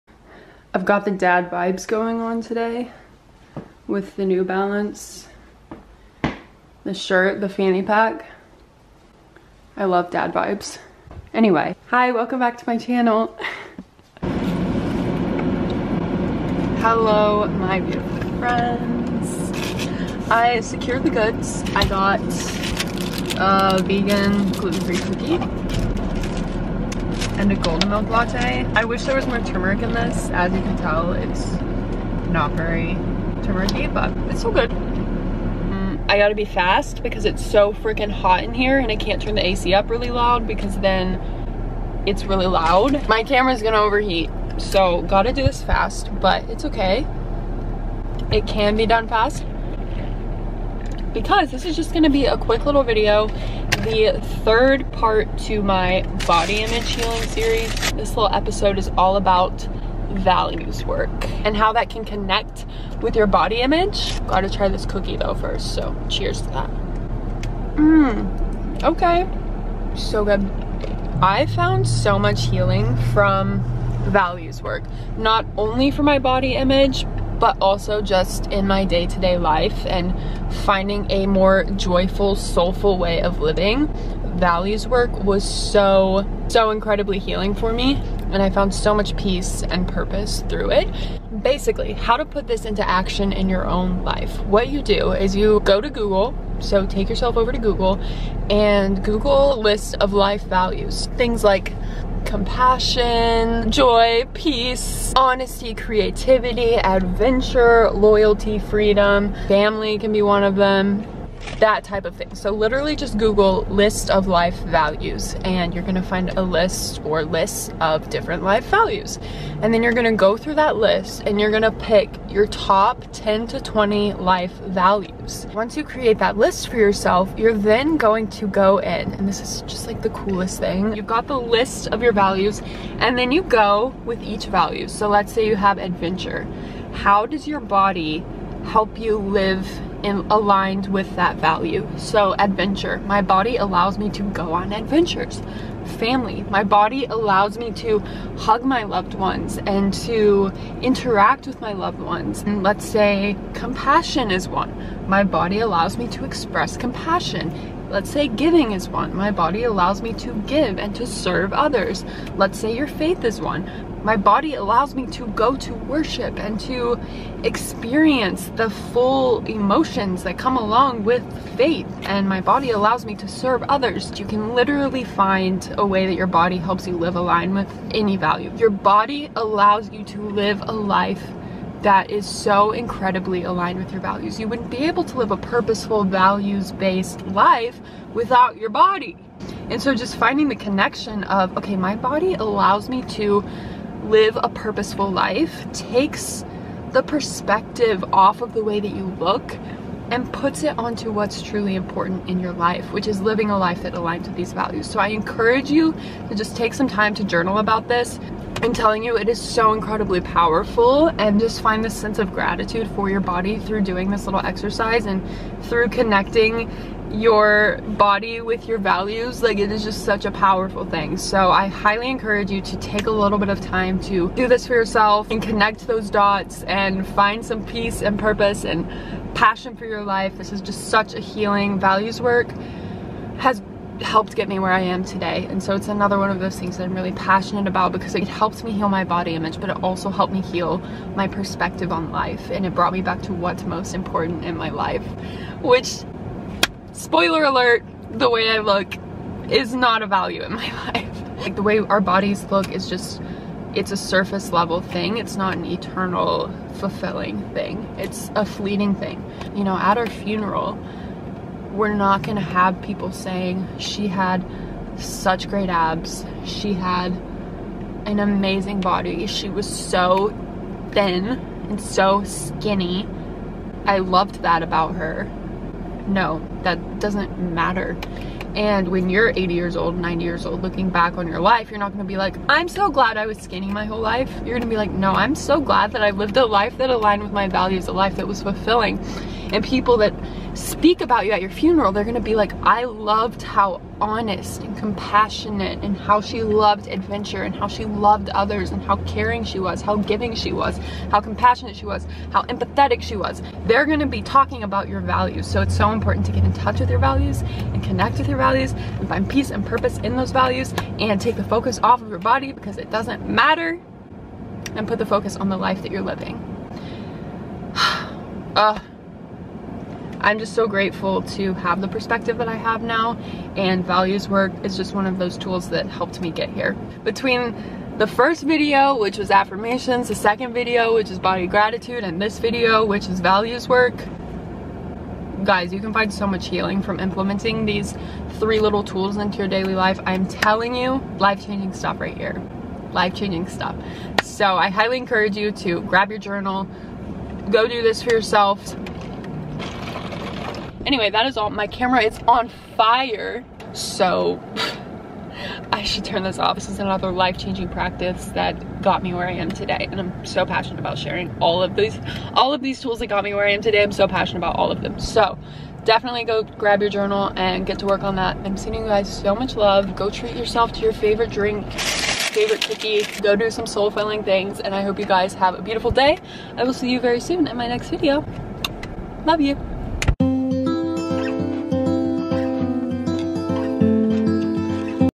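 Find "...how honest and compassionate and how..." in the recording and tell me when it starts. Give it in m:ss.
4:53.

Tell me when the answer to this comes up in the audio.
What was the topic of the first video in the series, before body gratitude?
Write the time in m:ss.
5:29.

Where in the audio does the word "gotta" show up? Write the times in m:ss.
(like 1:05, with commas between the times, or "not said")
0:36, 0:45, 1:04.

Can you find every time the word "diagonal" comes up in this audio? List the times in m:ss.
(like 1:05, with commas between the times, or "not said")
not said.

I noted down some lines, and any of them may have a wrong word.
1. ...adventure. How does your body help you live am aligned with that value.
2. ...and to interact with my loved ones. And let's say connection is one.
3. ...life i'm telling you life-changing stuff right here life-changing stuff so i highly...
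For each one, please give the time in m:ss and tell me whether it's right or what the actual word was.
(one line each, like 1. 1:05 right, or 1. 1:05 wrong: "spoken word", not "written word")
1. 2:15 right
2. 2:29 wrong: "compassion", not "connection"
3. 5:39 right.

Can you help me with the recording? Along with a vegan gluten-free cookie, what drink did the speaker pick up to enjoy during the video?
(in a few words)
golden milk latte.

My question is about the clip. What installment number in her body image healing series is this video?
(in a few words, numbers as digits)
third.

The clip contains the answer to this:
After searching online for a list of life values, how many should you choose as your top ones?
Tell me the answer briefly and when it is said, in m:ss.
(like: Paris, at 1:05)
10 to 20, at 2:03.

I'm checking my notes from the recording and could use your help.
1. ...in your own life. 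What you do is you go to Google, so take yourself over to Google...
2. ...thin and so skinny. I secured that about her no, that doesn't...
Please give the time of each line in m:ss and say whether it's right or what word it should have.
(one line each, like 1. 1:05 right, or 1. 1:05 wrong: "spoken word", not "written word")
1. 1:33 right
2. 4:30 wrong: "loved", not "secured".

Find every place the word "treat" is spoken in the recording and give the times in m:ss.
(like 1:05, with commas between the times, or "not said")
6:10.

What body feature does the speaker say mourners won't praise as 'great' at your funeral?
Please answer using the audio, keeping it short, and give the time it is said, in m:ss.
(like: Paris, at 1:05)
abs, at 4:25.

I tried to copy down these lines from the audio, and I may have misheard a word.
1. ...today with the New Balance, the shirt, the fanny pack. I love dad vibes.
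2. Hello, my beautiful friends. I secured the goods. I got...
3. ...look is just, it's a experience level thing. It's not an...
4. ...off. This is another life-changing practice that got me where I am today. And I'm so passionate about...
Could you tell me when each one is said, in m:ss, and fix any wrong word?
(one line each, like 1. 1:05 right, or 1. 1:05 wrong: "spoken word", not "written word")
1. 0:02 right
2. 0:16 right
3. 4:12 wrong: "surface", not "experience"
4. 5:56 right.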